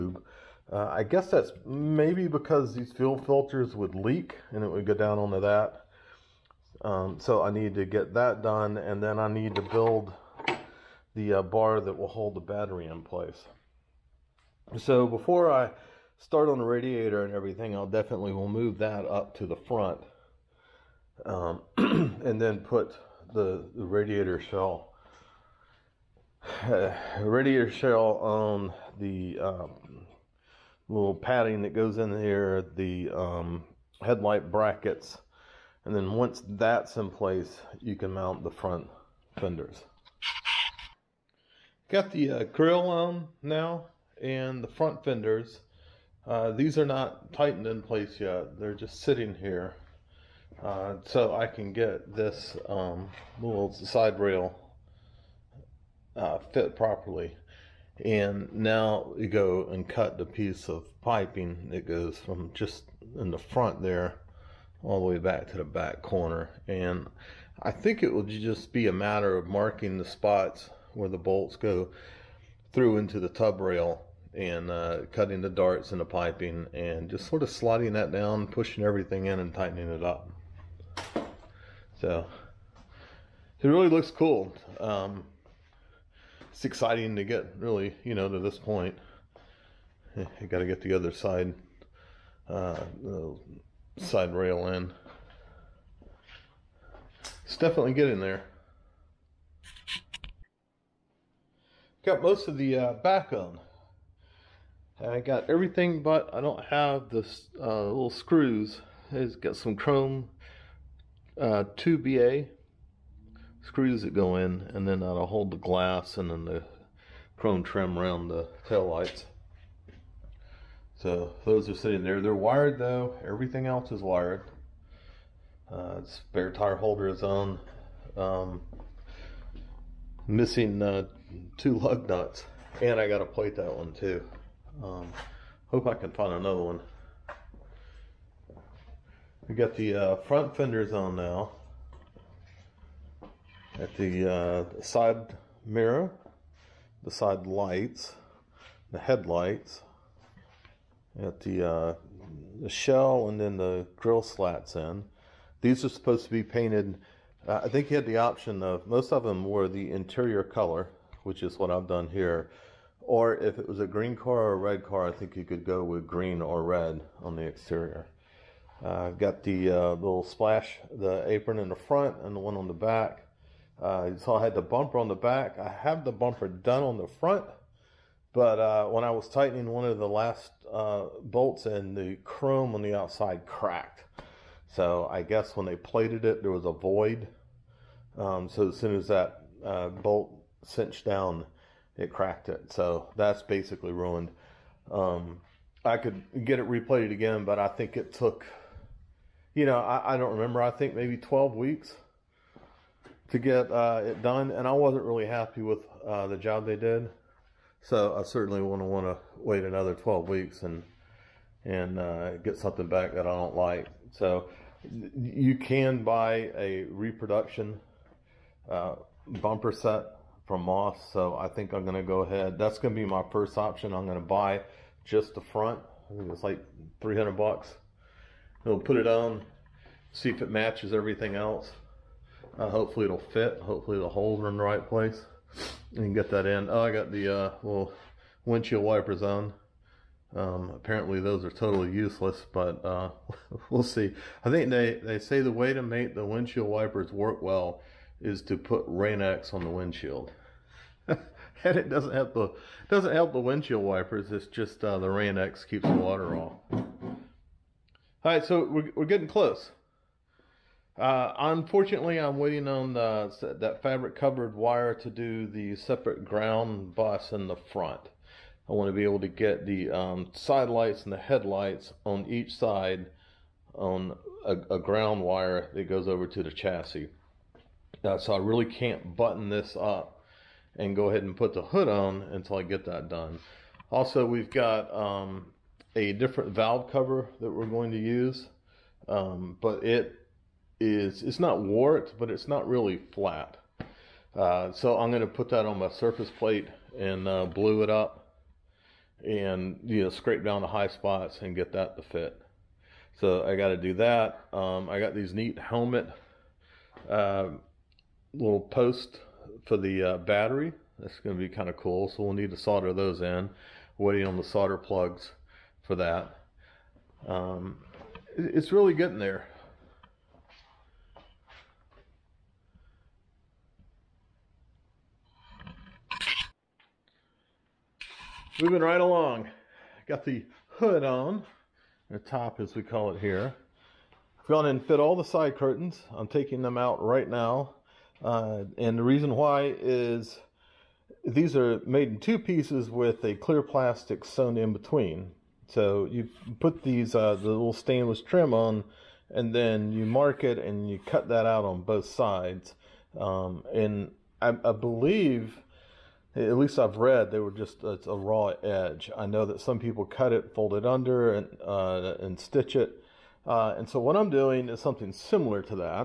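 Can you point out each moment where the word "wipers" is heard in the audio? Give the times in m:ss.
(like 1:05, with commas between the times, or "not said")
3:58, 4:06, 4:13.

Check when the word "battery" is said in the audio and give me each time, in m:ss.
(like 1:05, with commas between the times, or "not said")
0:12, 5:10.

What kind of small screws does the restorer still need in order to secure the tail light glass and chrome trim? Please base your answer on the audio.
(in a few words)
2BA screws.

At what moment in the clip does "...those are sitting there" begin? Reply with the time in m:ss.
2:01.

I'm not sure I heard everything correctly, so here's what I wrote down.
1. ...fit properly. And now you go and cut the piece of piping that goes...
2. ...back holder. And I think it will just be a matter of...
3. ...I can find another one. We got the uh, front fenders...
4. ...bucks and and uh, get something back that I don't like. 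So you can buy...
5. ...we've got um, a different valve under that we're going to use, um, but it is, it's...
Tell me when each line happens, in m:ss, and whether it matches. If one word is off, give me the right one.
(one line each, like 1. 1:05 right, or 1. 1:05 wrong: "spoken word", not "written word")
1. 0:56 right
2. 1:05 wrong: "corner", not "holder"
3. 2:15 right
4. 3:30 wrong: "weeks", not "bucks"
5. 4:44 wrong: "cover", not "under".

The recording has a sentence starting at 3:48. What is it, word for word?
We'll put it on, see if it matches everything else.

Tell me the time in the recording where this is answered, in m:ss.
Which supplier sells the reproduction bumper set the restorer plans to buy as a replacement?
3:40.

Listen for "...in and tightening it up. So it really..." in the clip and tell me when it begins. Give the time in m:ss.
1:19.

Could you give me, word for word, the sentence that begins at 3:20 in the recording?
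I think maybe 12 weeks to get uh, it done, and I wasn't really happy with uh, the job they did.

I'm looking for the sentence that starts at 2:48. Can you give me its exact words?
Uh, got the uh, little splash, the apron in the front and the one on the back.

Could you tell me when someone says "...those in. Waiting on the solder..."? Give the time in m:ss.
5:12.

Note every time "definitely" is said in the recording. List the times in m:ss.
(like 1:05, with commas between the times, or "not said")
0:17, 1:37.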